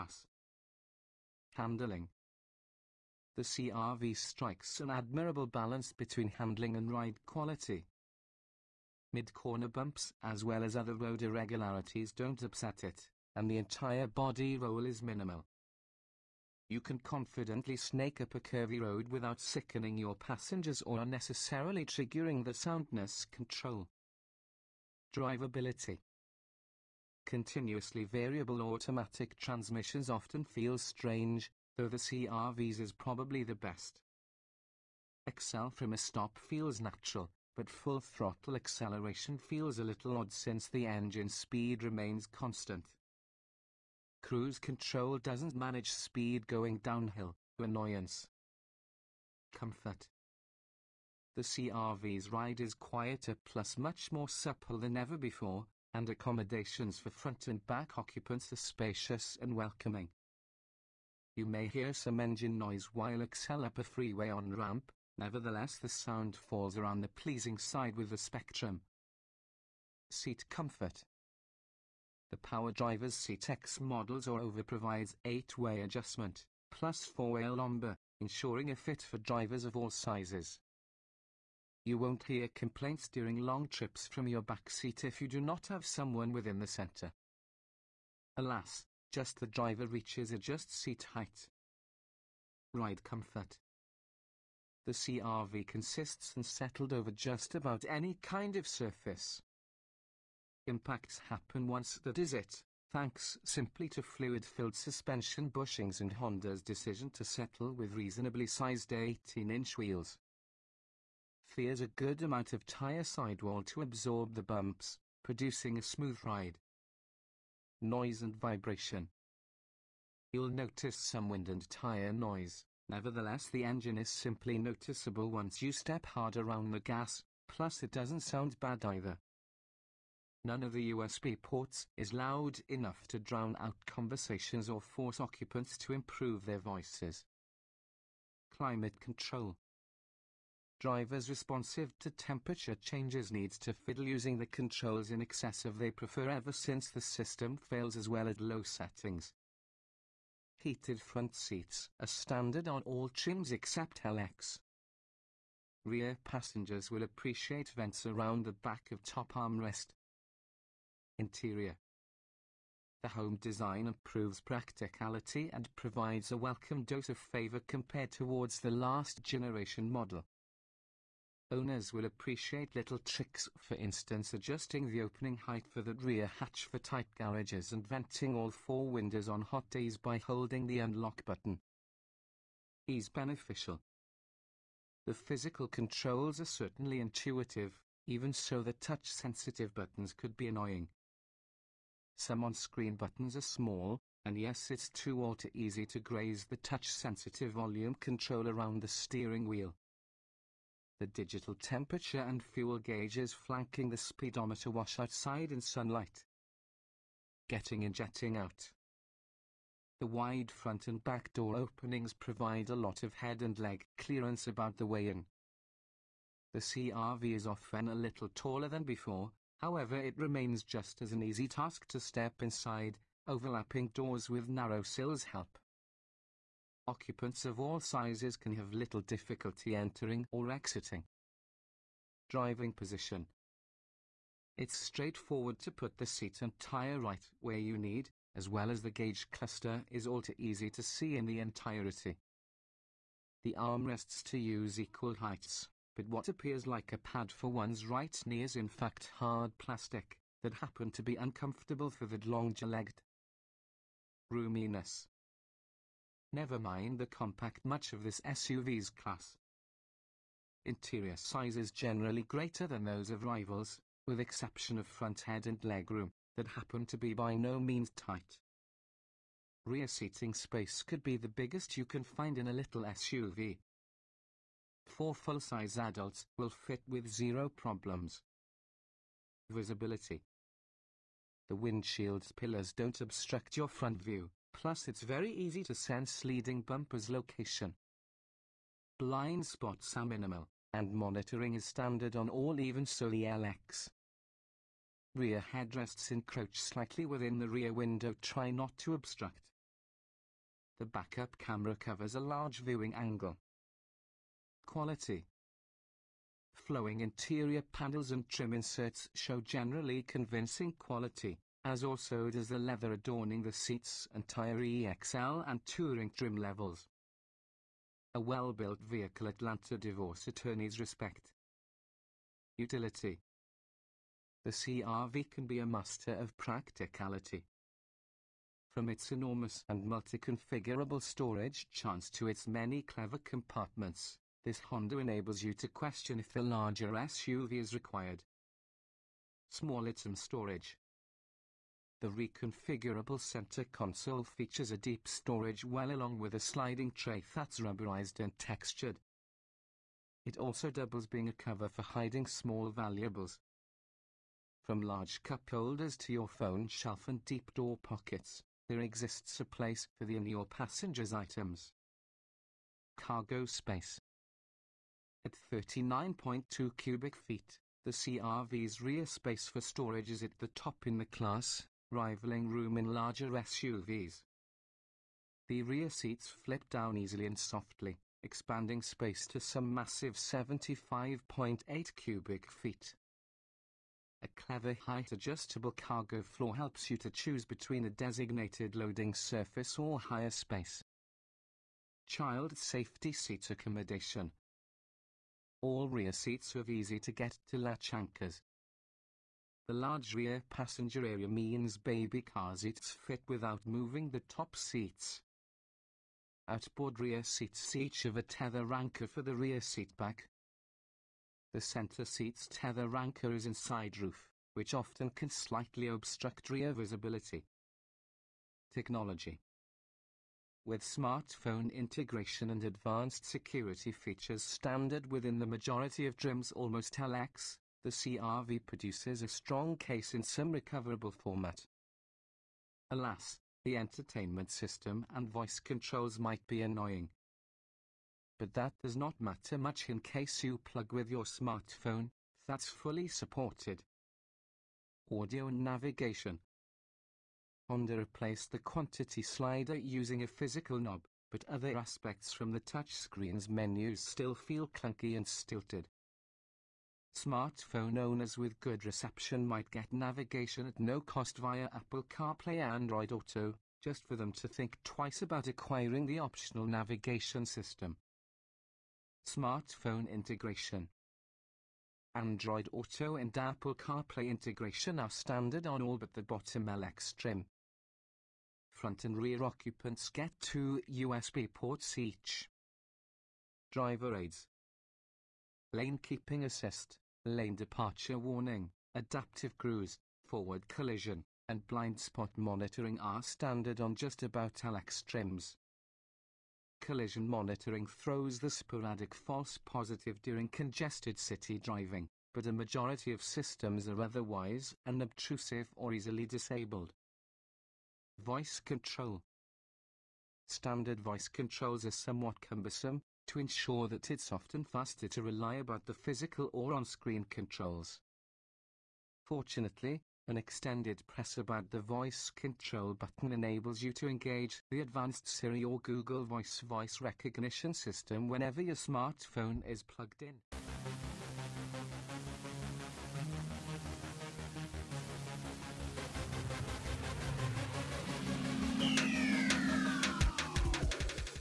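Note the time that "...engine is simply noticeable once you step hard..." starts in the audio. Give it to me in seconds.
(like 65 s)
123 s.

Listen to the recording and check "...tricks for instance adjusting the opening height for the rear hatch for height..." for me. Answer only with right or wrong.
wrong.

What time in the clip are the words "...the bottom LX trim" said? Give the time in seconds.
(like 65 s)
476 s.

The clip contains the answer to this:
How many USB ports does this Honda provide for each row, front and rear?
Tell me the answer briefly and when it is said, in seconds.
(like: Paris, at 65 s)
2, at 480 s.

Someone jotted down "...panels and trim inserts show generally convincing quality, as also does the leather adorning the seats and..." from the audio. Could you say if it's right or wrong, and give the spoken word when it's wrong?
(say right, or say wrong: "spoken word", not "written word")
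right.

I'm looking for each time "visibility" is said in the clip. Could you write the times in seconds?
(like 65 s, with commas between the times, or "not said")
279 s, 416 s.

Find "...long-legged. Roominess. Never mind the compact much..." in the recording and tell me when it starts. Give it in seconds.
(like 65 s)
252 s.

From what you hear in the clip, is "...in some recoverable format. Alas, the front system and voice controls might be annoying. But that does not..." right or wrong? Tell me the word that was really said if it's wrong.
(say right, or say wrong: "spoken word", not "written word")
wrong: "entertainment", not "front".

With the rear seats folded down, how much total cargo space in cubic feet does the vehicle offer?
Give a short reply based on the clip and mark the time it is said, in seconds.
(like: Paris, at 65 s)
75.8 cubic feet, at 380 s.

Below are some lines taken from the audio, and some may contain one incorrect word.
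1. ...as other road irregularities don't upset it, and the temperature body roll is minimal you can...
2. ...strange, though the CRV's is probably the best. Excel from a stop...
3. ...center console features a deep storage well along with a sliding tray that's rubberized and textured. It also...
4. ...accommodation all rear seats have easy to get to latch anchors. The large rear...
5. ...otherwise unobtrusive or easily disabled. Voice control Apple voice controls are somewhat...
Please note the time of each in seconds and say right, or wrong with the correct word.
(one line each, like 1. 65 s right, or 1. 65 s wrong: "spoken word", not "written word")
1. 10 s wrong: "entire", not "temperature"
2. 30 s right
3. 343 s right
4. 393 s right
5. 504 s wrong: "Standard", not "Apple".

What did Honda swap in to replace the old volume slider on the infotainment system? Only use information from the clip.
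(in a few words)
A physical knob.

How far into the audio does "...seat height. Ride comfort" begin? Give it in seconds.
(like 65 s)
90 s.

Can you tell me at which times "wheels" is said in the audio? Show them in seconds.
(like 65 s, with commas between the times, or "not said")
109 s, 199 s.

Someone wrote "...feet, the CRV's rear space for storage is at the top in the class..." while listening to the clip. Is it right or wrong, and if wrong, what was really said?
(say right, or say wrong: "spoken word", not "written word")
right.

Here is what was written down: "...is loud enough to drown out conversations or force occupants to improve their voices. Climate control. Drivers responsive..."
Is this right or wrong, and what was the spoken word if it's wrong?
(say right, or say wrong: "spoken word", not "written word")
right.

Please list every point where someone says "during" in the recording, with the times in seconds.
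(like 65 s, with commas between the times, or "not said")
83 s, 500 s.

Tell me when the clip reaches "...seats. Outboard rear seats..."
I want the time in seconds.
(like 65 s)
404 s.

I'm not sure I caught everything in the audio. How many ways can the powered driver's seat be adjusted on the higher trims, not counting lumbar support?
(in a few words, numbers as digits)
8-way.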